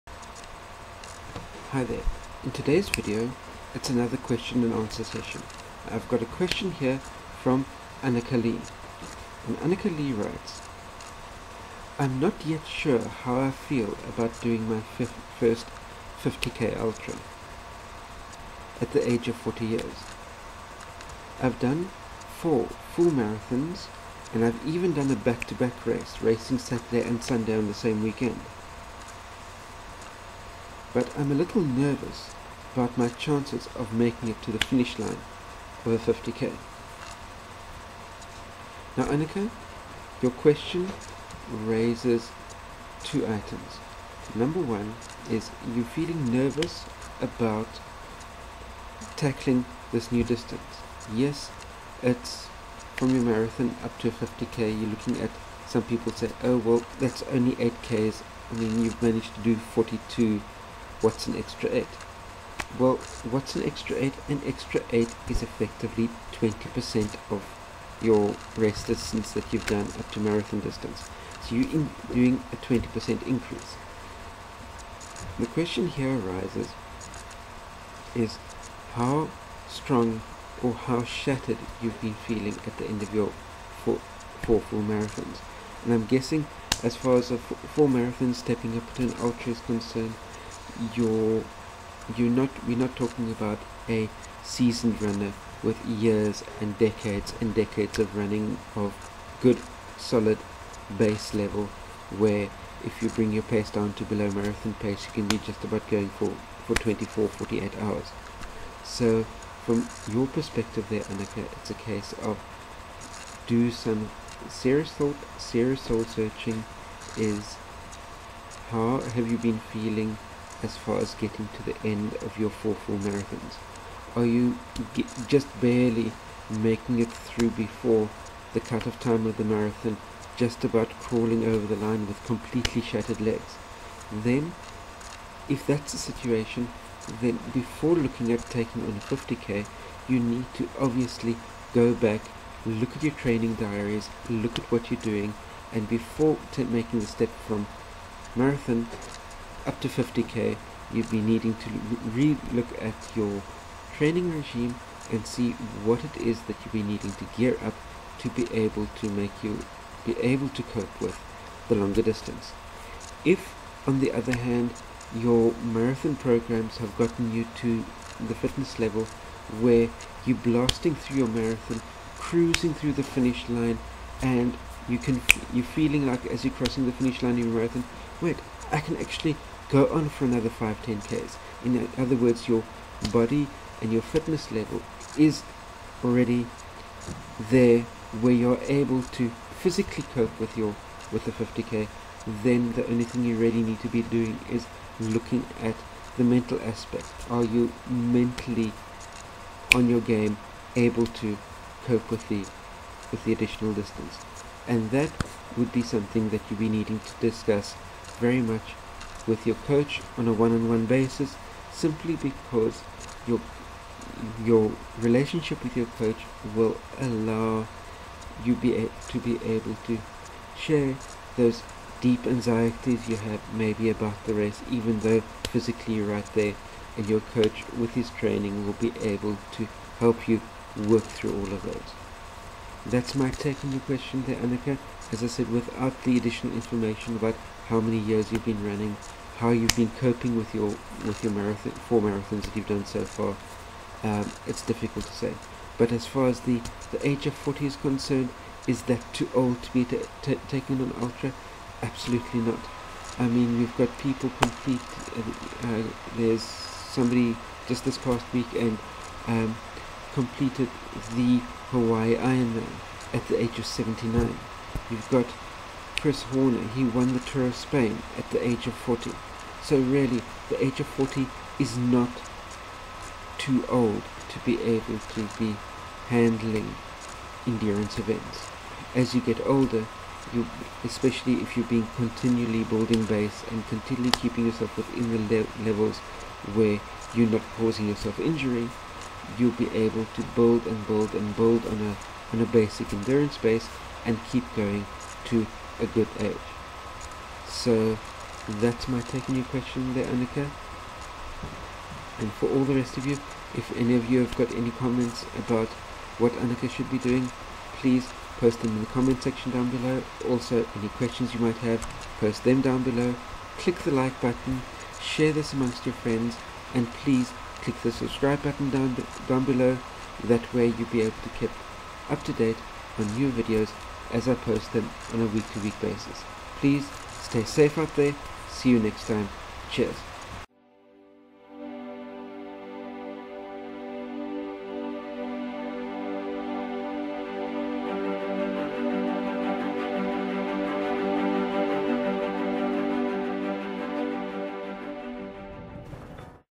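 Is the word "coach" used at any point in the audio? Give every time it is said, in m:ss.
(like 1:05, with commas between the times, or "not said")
3:29, 3:35, 3:47.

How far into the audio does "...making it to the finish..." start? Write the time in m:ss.
0:33.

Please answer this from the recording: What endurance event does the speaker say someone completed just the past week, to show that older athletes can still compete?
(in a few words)
Hawaii Ironman.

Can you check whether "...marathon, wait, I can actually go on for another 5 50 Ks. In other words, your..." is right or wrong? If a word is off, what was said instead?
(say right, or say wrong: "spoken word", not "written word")
wrong: "10", not "50".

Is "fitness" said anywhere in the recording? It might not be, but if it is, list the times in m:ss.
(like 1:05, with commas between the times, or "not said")
2:48, 3:04.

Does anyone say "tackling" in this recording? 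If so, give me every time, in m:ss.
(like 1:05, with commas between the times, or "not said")
0:49.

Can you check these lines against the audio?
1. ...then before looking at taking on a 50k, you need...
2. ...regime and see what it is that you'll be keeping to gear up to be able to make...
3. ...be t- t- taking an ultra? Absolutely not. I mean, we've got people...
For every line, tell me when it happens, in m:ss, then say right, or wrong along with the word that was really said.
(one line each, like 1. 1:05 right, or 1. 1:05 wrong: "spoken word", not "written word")
1. 2:17 right
2. 2:34 wrong: "needing", not "keeping"
3. 4:09 right.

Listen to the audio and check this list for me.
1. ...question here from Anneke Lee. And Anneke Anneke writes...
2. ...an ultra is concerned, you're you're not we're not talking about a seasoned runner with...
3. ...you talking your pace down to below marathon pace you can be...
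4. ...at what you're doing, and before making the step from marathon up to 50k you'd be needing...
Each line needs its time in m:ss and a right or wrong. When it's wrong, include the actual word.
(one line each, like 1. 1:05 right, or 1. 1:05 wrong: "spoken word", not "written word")
1. 0:06 wrong: "Lee", not "Anneke"
2. 1:29 right
3. 1:43 wrong: "bring", not "talking"
4. 2:24 right.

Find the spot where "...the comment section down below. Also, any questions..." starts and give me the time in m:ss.
5:08.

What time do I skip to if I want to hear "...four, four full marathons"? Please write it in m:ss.
1:23.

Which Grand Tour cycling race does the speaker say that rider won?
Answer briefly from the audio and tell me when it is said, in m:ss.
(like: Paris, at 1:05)
Tour of Spain, at 4:27.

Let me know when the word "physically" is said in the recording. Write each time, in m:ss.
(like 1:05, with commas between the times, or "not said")
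3:09, 3:45.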